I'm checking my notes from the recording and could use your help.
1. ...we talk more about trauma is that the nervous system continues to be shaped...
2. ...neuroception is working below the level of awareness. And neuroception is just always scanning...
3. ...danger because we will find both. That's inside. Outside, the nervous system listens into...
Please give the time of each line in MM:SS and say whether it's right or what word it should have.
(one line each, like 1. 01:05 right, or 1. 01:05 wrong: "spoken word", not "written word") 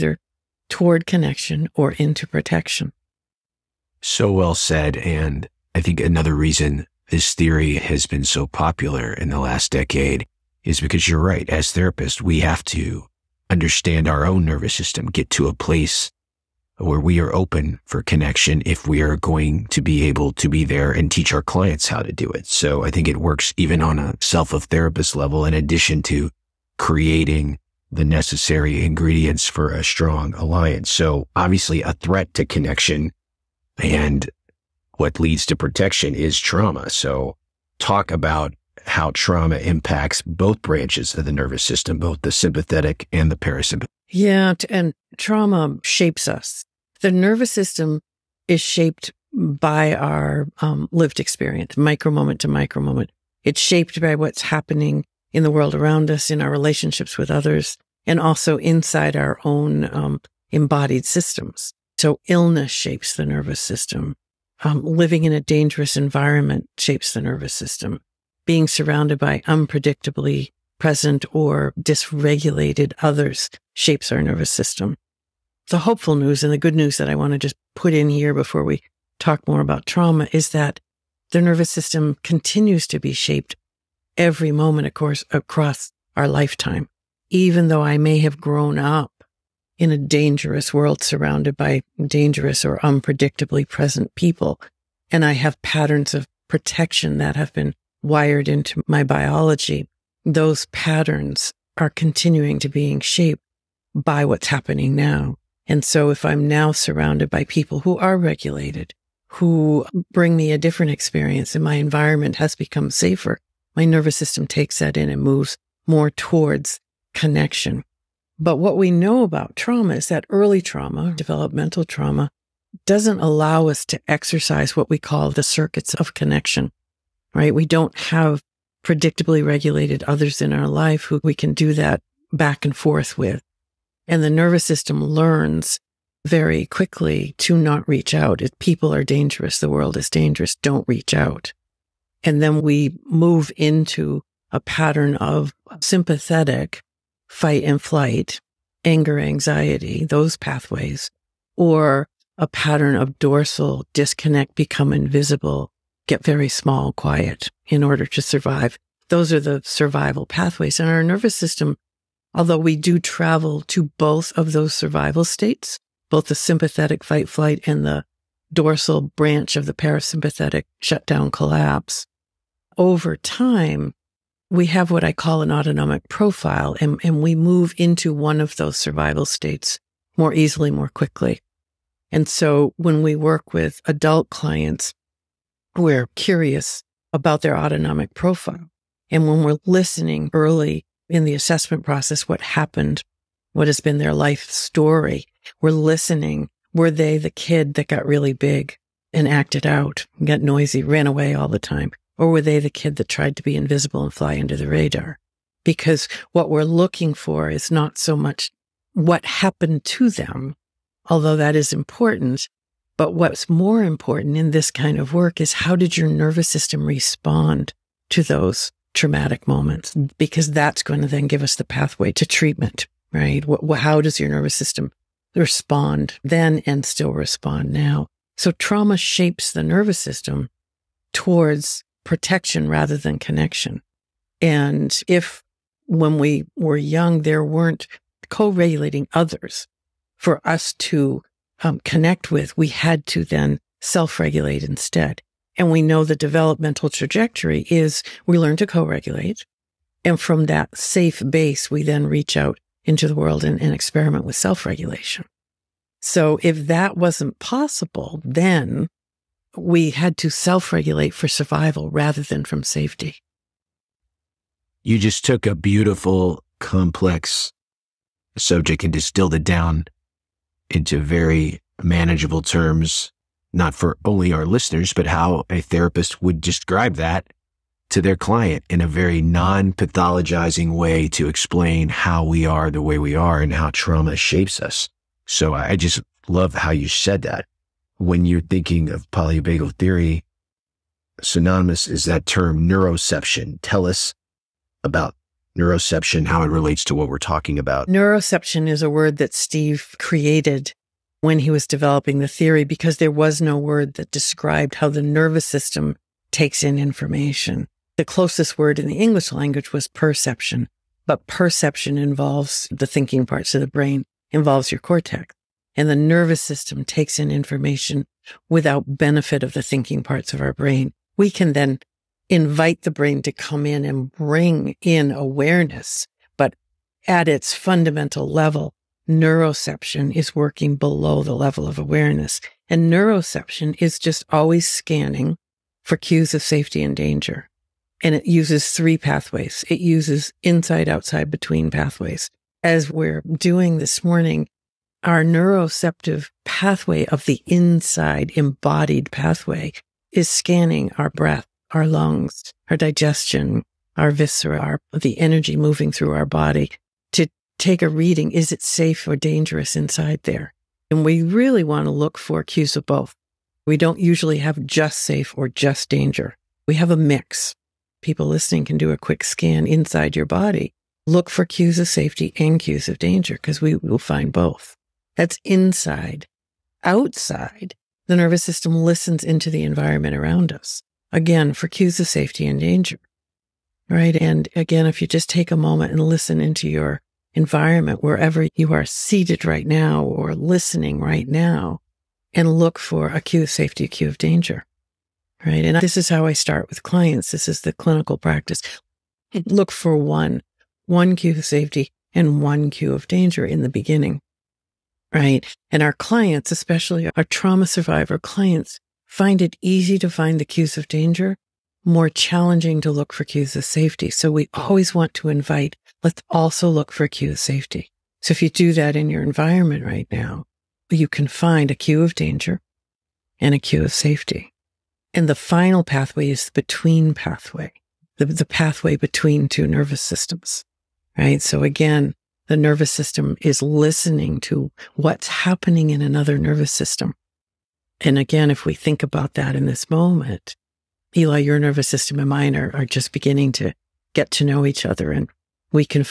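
1. 01:18 right
2. 05:29 right
3. 06:12 right.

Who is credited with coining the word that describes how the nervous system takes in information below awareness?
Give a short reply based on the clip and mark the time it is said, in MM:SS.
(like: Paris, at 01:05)
Steve, at 04:59.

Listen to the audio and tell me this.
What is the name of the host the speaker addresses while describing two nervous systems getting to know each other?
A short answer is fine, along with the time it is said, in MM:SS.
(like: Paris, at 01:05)
Eli, at 07:21.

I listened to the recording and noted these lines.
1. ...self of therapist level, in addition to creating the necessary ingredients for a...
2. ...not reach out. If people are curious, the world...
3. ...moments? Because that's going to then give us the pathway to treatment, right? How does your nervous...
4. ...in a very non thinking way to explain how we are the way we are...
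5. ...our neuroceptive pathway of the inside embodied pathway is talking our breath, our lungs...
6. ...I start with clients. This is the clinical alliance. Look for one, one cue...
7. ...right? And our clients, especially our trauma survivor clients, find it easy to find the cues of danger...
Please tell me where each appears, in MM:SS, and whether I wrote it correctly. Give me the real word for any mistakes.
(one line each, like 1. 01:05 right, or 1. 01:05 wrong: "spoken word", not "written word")
1. 00:24 right
2. 02:17 wrong: "dangerous", not "curious"
3. 03:39 right
4. 04:38 wrong: "pathologizing", not "thinking"
5. 05:45 wrong: "scanning", not "talking"
6. 06:36 wrong: "practice", not "alliance"
7. 06:45 right.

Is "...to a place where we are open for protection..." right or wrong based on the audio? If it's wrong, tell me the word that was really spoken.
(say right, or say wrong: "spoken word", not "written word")
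wrong: "connection", not "protection".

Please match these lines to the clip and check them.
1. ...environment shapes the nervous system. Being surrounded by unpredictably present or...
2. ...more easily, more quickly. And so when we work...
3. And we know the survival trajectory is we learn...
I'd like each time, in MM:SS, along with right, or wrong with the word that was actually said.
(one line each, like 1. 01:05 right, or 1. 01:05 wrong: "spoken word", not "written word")
1. 01:05 right
2. 03:00 right
3. 04:05 wrong: "developmental", not "survival".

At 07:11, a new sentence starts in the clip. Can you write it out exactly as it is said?
So again, the nervous system is listening to what's happening in another nervous system.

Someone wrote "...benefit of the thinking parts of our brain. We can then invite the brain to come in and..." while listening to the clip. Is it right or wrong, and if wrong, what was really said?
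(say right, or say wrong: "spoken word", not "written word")
right.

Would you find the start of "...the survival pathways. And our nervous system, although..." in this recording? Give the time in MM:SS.
02:39.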